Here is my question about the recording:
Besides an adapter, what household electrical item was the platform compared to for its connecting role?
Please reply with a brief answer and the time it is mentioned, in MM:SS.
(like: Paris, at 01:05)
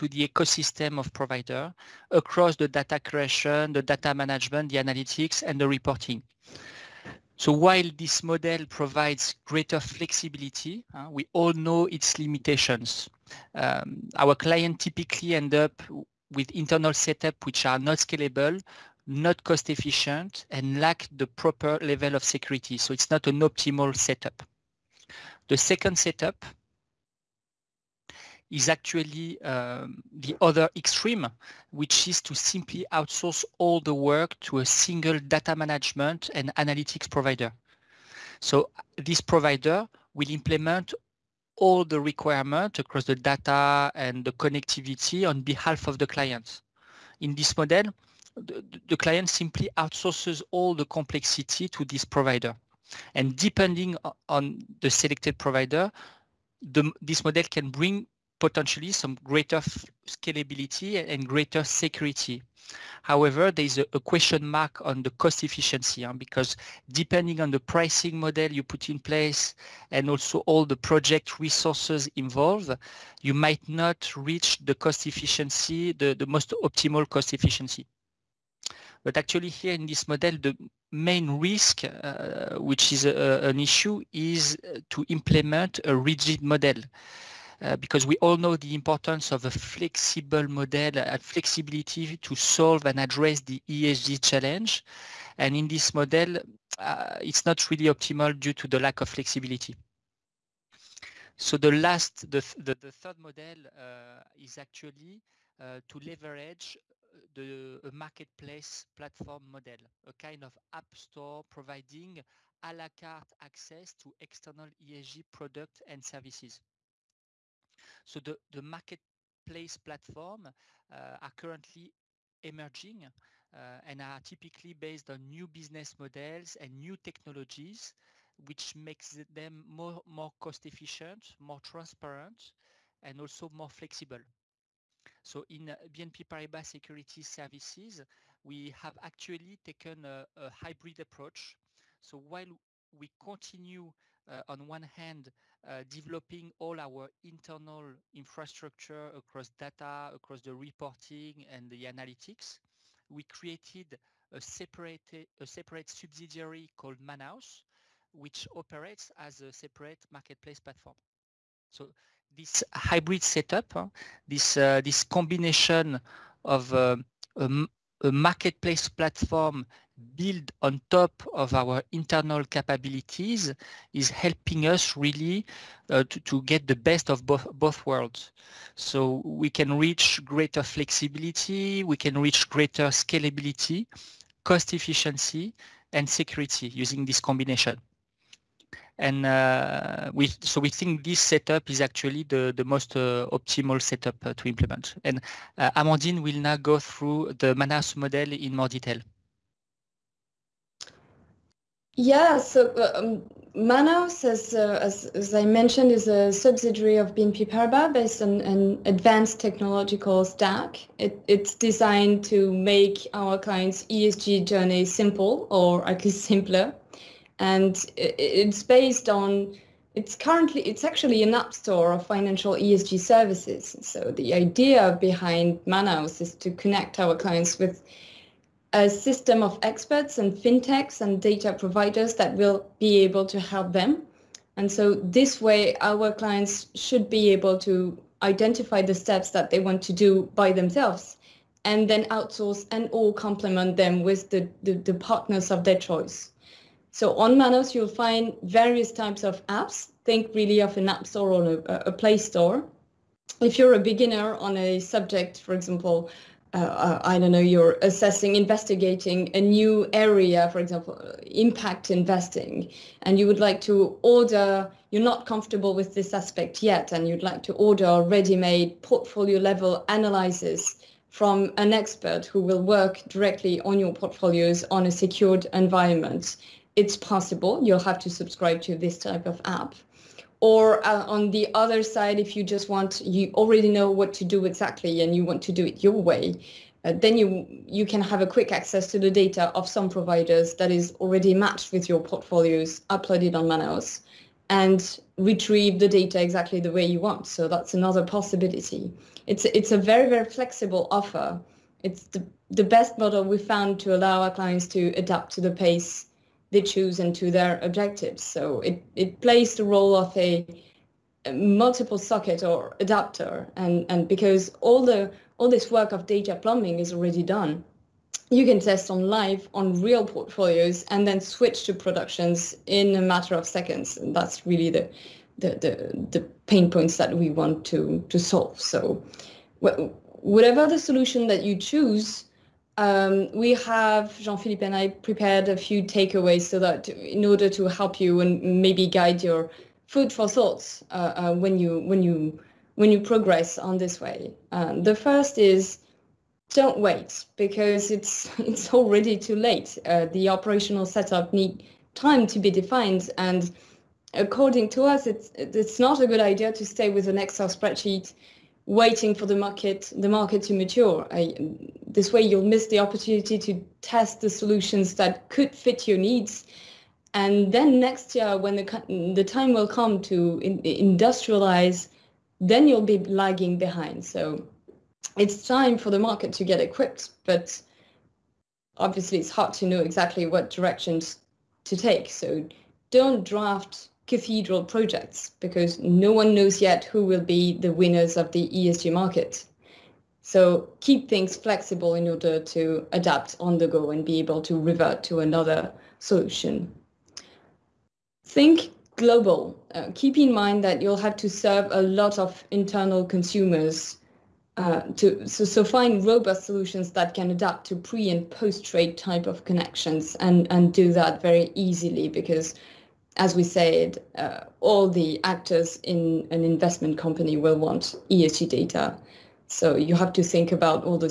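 multiple socket, at 05:11.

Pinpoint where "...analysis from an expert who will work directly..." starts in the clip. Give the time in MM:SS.
04:29.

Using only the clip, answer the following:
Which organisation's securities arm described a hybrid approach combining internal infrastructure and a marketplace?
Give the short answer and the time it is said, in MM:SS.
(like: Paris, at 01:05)
BNP Paribas Security Services, at 02:15.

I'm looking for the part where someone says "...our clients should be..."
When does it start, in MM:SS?
03:55.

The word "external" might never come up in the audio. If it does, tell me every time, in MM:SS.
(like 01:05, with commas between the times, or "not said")
01:54.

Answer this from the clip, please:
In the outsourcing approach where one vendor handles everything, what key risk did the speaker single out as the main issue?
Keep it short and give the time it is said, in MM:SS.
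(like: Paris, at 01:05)
rigid model, at 01:25.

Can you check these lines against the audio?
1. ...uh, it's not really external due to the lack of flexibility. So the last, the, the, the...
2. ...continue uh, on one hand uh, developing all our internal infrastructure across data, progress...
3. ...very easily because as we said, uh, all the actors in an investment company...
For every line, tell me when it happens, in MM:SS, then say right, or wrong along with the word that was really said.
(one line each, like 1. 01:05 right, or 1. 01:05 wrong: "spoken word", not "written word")
1. 01:36 wrong: "optimal", not "external"
2. 02:23 wrong: "across", not "progress"
3. 06:51 right.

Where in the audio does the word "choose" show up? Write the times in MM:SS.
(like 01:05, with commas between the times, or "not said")
05:06, 05:31.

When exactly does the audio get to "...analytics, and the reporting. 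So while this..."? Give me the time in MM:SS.
00:04.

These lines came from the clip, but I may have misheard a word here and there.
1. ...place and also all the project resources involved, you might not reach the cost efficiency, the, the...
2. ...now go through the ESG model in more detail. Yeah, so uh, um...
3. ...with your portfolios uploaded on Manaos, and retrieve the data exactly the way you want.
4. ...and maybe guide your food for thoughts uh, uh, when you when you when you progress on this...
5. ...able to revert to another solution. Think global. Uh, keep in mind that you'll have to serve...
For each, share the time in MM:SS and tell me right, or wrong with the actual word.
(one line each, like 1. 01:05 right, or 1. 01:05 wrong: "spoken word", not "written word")
1. 01:08 right
2. 03:16 wrong: "Manaos", not "ESG"
3. 04:51 right
4. 05:38 right
5. 06:34 right.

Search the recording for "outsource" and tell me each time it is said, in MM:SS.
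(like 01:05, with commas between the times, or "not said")
00:32, 00:49, 04:02.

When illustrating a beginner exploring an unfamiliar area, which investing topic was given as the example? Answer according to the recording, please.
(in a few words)
impact investing.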